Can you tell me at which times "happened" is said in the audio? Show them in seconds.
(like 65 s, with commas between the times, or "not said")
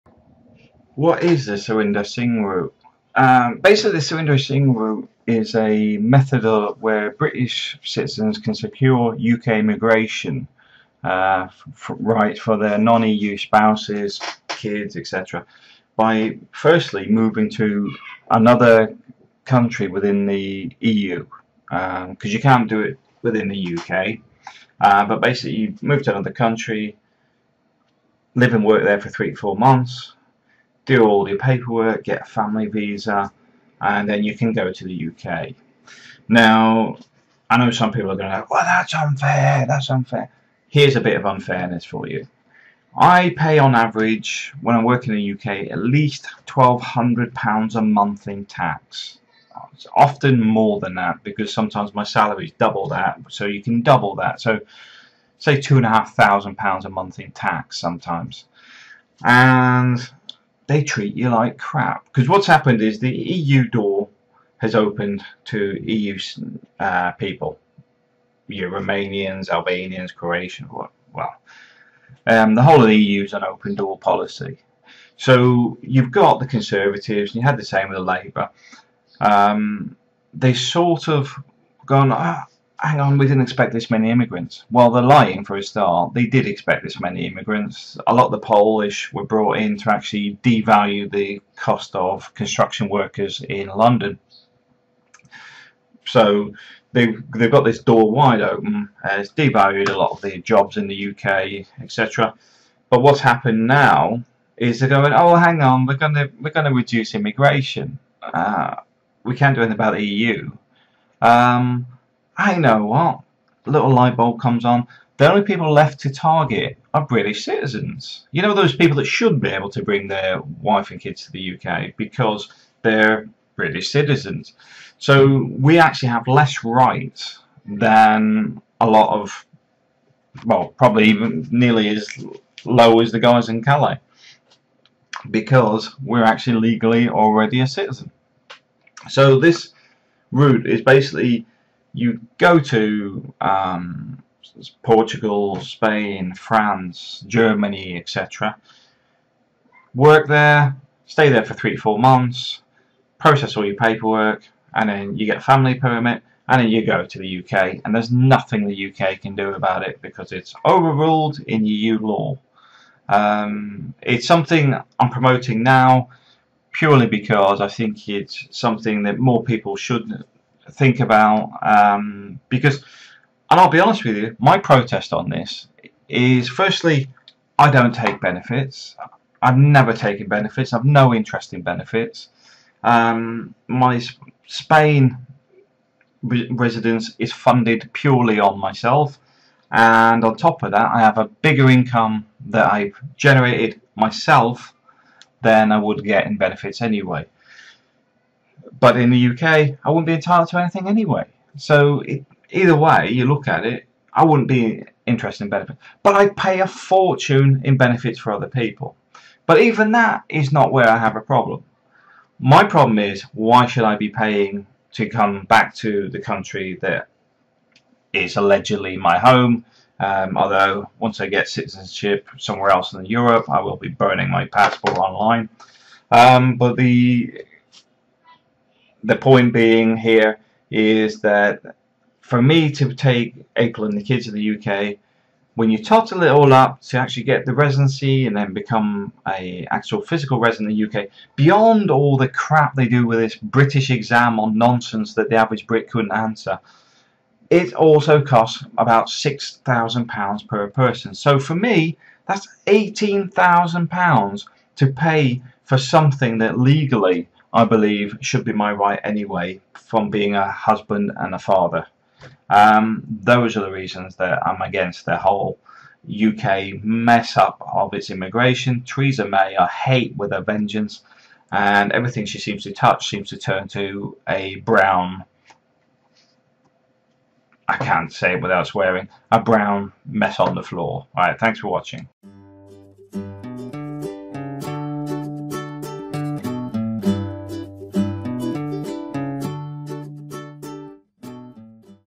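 62 s, 103 s.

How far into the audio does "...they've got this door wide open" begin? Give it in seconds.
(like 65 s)
97 s.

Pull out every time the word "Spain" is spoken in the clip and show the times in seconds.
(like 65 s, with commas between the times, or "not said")
145 s, 184 s.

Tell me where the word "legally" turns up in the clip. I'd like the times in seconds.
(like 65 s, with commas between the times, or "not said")
136 s, 256 s.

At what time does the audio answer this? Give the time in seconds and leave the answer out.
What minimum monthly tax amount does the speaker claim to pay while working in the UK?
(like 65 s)
46 s.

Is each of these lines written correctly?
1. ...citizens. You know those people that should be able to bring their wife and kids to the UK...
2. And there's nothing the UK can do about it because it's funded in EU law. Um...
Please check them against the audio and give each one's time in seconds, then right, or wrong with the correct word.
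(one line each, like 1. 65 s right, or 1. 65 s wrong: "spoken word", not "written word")
1. 117 s right
2. 157 s wrong: "overruled", not "funded".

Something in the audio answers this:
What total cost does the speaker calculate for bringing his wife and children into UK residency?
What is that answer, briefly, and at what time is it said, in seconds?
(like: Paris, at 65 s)
£18,000, at 252 s.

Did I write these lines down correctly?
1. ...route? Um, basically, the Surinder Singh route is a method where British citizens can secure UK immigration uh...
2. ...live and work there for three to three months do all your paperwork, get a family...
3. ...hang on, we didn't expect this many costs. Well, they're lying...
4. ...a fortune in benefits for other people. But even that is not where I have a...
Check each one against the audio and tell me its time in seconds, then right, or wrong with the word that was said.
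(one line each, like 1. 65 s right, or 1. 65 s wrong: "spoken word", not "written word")
1. 2 s right
2. 28 s wrong: "four", not "three"
3. 82 s wrong: "immigrants", not "costs"
4. 206 s right.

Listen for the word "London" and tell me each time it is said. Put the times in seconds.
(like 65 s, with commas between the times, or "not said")
93 s.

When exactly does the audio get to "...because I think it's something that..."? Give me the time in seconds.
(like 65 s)
167 s.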